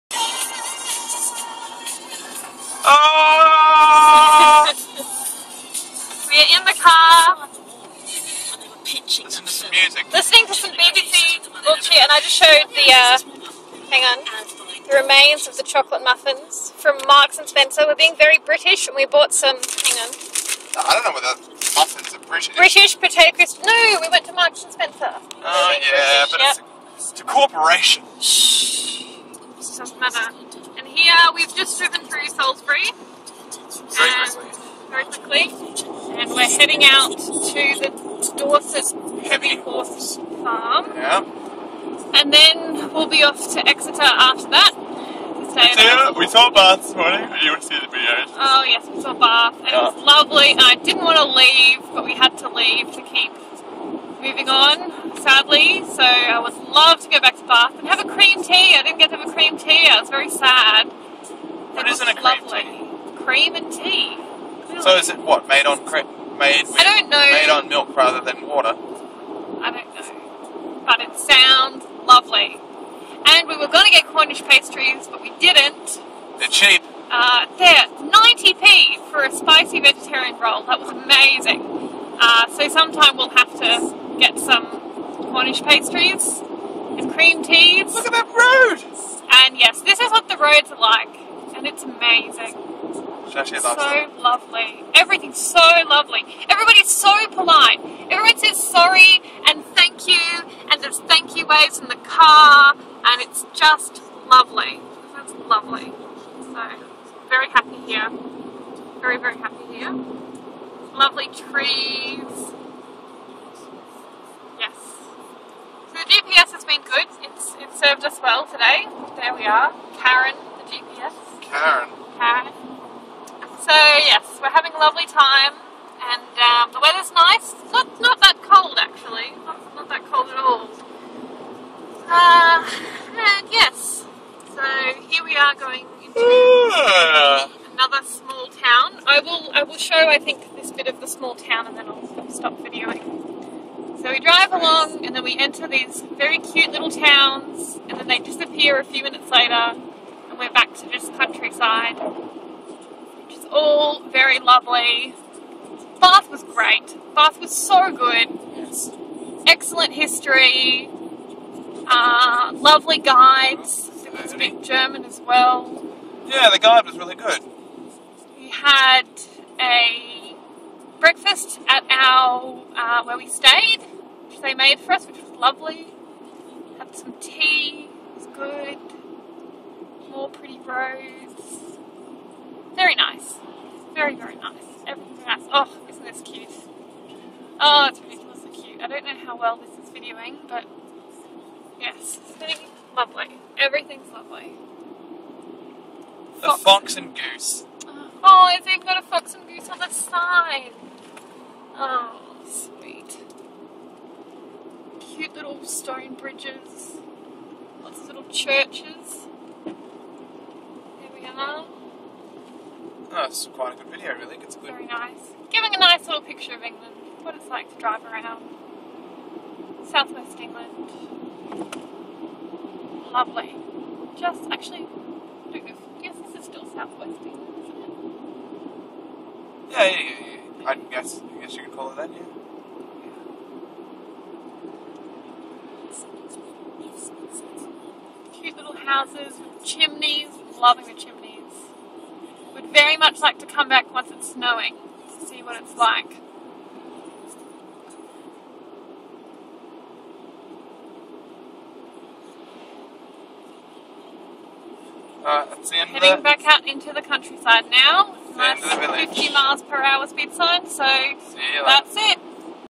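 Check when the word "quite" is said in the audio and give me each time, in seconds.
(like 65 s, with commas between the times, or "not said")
213 s.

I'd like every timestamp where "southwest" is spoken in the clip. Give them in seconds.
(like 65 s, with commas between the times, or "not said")
219 s, 226 s.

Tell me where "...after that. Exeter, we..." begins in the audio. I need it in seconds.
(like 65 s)
44 s.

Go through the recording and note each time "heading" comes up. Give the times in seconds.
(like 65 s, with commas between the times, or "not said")
36 s, 255 s.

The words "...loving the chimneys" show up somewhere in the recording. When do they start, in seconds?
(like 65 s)
240 s.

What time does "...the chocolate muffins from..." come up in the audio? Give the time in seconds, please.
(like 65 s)
15 s.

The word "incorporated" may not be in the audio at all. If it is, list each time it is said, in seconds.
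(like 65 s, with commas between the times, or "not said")
not said.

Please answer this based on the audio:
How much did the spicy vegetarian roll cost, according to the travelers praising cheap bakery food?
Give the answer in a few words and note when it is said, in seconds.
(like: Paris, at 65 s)
90p, at 78 s.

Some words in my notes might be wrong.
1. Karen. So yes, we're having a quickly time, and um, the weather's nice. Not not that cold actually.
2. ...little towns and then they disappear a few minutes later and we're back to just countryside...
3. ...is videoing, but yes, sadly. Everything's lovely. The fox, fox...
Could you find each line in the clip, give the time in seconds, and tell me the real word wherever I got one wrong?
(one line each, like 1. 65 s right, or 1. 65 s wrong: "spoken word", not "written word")
1. 122 s wrong: "lovely", not "quickly"
2. 146 s right
3. 189 s wrong: "lovely", not "sadly".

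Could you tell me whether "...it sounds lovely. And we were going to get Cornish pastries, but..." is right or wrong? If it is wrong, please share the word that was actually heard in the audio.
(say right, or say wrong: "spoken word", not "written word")
right.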